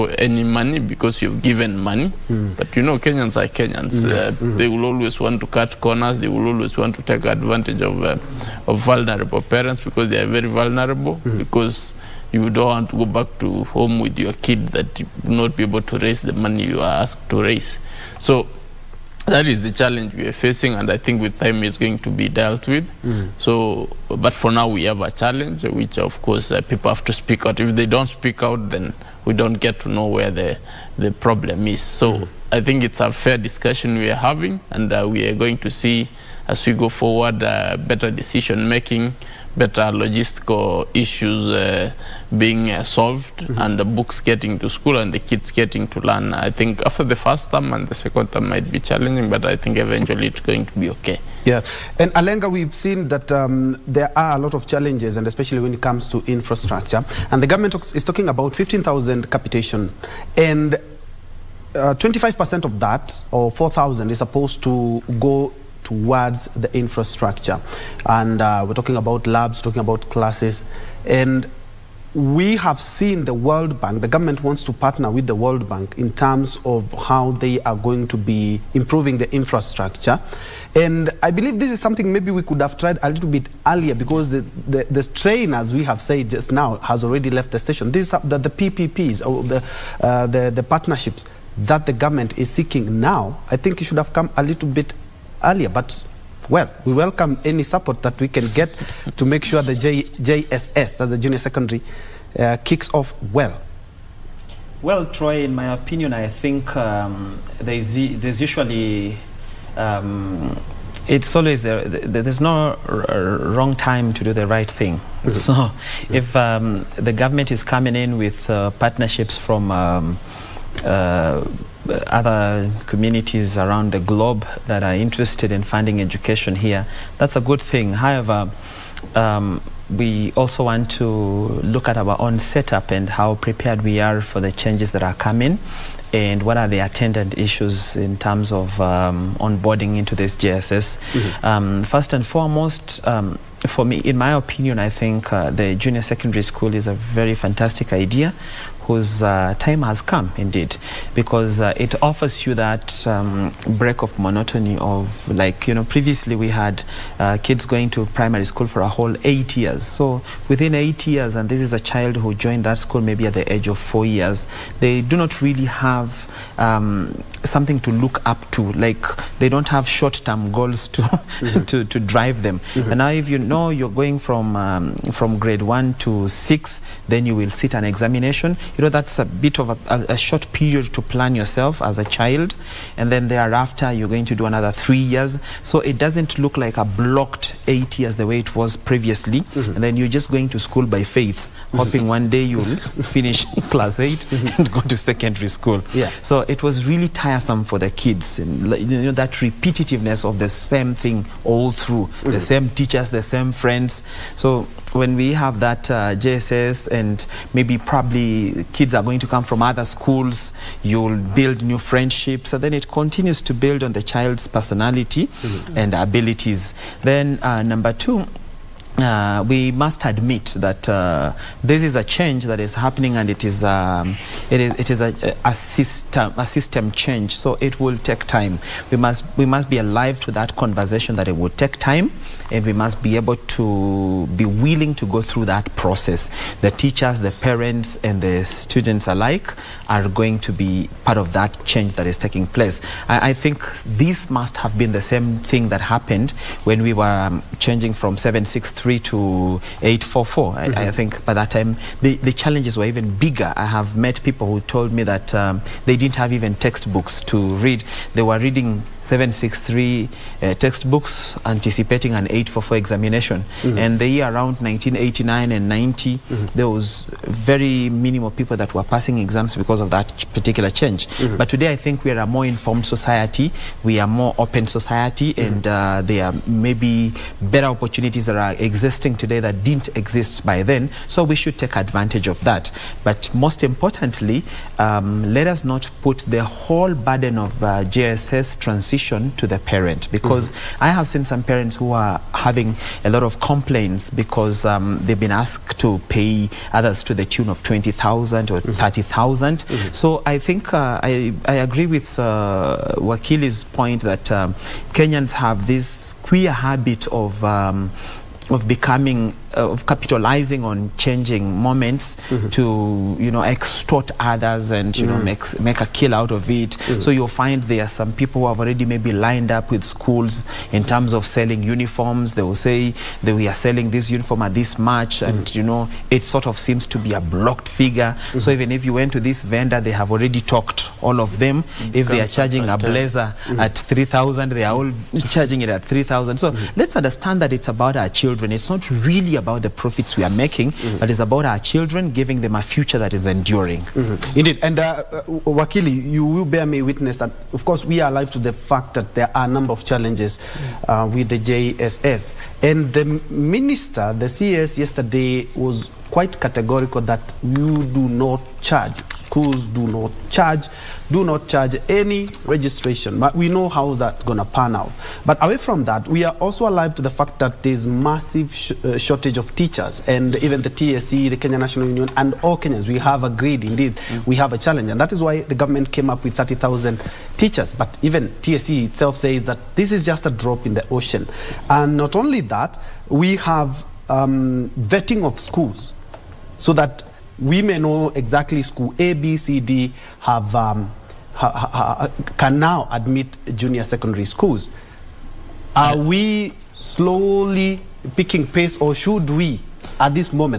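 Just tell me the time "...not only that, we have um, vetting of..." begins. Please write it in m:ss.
6:21.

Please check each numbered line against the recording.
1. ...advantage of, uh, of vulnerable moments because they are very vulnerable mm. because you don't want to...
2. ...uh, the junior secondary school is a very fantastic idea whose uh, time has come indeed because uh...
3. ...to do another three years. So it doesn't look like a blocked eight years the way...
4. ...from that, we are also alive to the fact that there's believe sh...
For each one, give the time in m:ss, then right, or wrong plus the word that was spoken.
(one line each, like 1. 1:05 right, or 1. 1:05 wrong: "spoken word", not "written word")
1. 0:07 wrong: "parents", not "moments"
2. 2:25 right
3. 3:04 right
4. 6:05 wrong: "massive", not "believe".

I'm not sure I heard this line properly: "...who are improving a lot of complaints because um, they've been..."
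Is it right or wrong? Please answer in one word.
wrong.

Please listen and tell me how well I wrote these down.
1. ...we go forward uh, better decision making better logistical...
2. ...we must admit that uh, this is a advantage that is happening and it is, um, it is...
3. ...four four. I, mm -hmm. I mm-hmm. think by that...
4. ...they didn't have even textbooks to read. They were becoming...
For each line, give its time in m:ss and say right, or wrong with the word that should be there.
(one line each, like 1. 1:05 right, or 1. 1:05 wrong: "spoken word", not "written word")
1. 0:36 right
2. 3:39 wrong: "change", not "advantage"
3. 4:10 right
4. 4:15 wrong: "reading", not "becoming".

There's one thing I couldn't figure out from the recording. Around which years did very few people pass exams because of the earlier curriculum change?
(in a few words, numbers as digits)
1989 and 1990.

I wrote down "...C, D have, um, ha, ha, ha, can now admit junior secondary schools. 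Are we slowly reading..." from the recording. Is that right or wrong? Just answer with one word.
wrong.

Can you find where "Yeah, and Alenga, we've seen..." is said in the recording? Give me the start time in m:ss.
0:51.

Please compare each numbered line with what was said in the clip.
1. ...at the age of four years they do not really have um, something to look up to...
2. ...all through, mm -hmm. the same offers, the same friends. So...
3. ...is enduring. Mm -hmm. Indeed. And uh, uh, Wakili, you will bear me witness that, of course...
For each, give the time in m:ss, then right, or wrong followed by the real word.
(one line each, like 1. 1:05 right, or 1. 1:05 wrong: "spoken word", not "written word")
1. 2:43 right
2. 3:21 wrong: "teachers", not "offers"
3. 5:43 right.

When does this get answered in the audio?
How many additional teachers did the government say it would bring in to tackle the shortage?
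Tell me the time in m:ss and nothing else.
6:16.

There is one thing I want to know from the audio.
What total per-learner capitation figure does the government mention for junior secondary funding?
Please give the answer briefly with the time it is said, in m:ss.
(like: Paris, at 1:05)
15,000, at 0:58.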